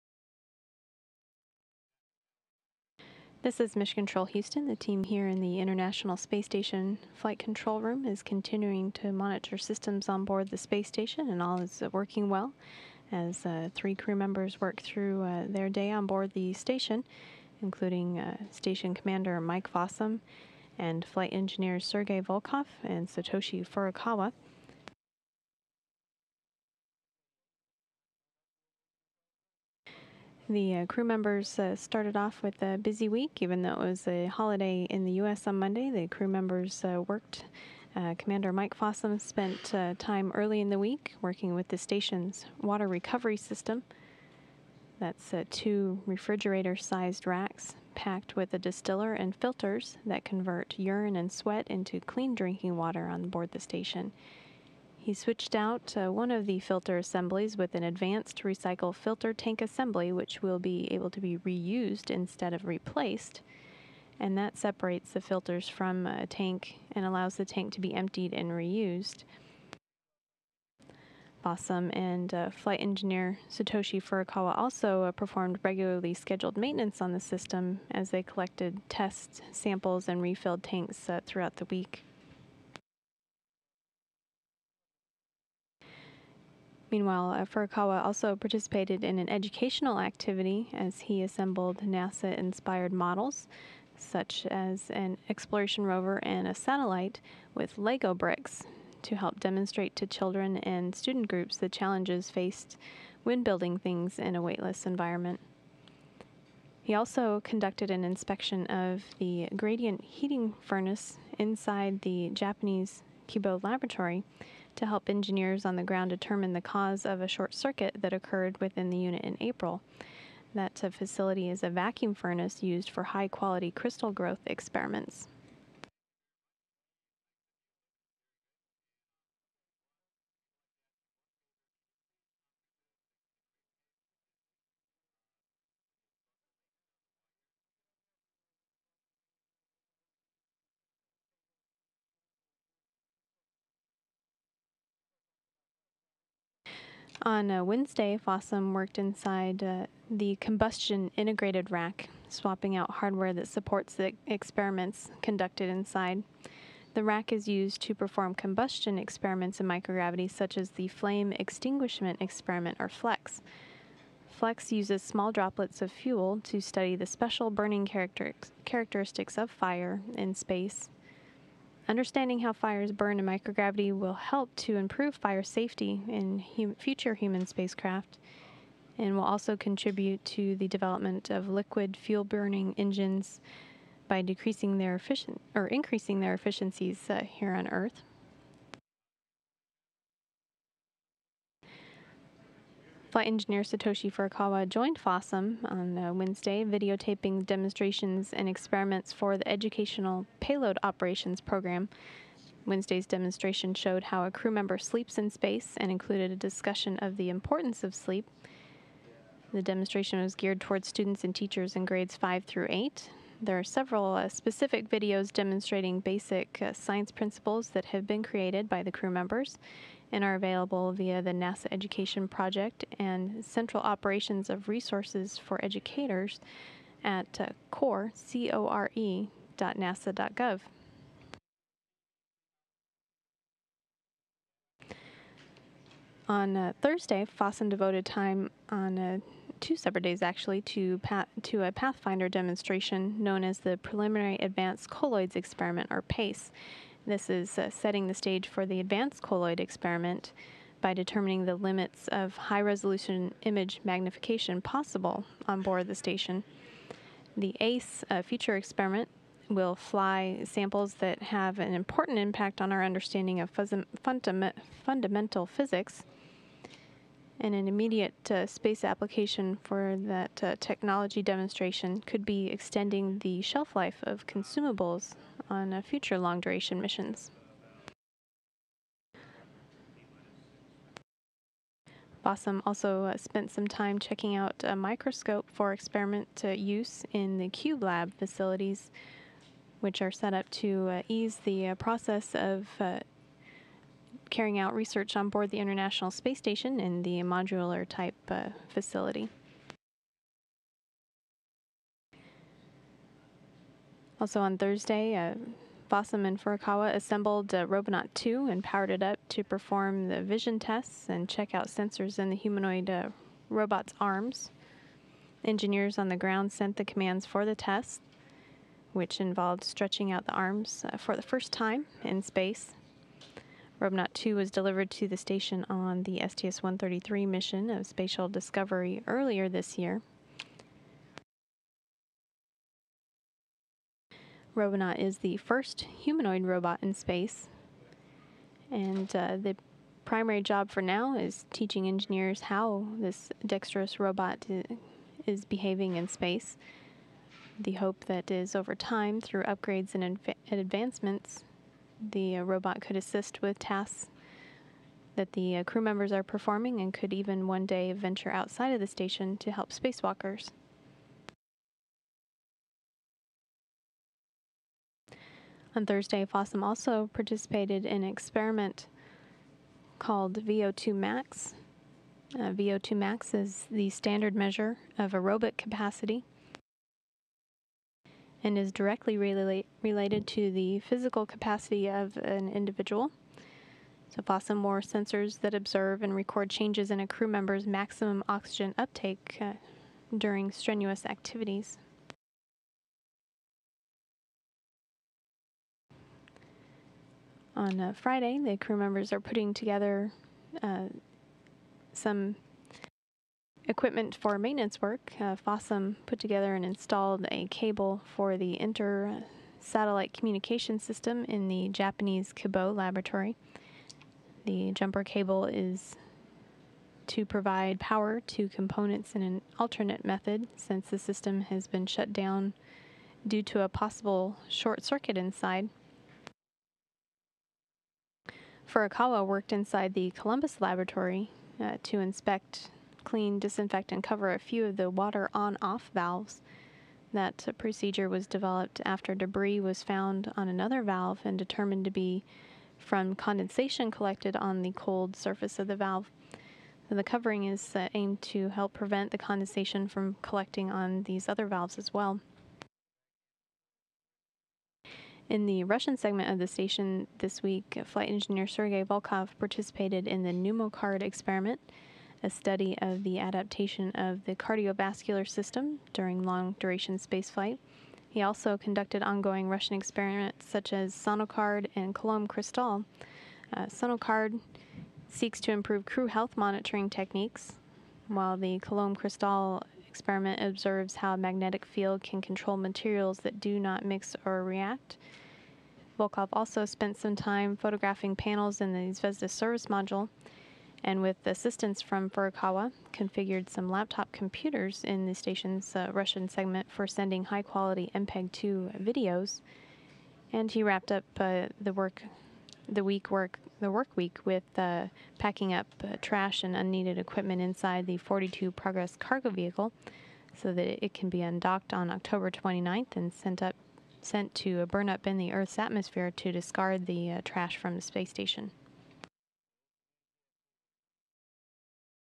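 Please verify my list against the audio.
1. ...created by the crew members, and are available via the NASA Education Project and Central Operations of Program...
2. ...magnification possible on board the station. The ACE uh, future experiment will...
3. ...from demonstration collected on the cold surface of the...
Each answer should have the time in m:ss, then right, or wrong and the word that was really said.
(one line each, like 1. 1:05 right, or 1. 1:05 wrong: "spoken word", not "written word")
1. 3:38 wrong: "Resources", not "Program"
2. 4:13 right
3. 7:22 wrong: "condensation", not "demonstration".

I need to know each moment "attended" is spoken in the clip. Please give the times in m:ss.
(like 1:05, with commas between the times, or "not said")
not said.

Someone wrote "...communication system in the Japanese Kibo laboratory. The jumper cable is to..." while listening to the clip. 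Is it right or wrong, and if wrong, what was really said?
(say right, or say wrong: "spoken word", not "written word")
right.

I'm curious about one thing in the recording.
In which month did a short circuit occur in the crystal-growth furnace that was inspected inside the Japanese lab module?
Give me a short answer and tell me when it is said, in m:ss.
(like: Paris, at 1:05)
April, at 1:59.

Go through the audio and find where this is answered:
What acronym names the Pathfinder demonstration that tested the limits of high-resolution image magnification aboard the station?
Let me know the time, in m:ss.
4:06.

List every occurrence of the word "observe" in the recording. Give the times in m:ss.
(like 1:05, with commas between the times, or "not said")
6:25, 8:00.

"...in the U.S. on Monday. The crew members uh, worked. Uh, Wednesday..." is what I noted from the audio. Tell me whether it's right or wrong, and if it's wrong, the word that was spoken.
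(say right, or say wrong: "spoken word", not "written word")
wrong: "Commander", not "Wednesday".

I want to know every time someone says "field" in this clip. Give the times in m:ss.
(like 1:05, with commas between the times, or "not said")
8:01.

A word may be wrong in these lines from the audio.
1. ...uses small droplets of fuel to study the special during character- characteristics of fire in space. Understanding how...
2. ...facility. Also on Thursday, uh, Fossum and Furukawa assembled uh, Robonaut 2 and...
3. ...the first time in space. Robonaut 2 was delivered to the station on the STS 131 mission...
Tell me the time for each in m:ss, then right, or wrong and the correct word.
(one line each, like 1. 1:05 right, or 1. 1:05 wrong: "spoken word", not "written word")
1. 2:44 wrong: "burning", not "during"
2. 4:58 right
3. 5:21 wrong: "133", not "131".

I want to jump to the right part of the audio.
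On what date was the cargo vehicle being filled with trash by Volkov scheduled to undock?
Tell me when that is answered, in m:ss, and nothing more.
8:31.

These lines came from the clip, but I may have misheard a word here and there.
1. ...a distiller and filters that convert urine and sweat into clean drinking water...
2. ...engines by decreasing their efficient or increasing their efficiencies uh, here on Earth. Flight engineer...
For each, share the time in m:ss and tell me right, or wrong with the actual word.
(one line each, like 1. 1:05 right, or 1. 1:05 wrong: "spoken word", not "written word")
1. 0:48 right
2. 3:02 right.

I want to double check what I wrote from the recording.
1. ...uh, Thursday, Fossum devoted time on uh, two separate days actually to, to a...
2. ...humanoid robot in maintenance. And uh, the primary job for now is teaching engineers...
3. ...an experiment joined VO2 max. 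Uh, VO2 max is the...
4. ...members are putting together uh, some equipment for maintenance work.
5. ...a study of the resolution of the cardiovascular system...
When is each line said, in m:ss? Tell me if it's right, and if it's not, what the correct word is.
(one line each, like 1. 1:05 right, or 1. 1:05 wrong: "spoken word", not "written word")
1. 3:56 right
2. 5:35 wrong: "space", not "maintenance"
3. 6:08 wrong: "called", not "joined"
4. 6:38 right
5. 7:42 wrong: "adaptation", not "resolution".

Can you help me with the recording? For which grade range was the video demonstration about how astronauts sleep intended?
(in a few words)
grades 5 through 8.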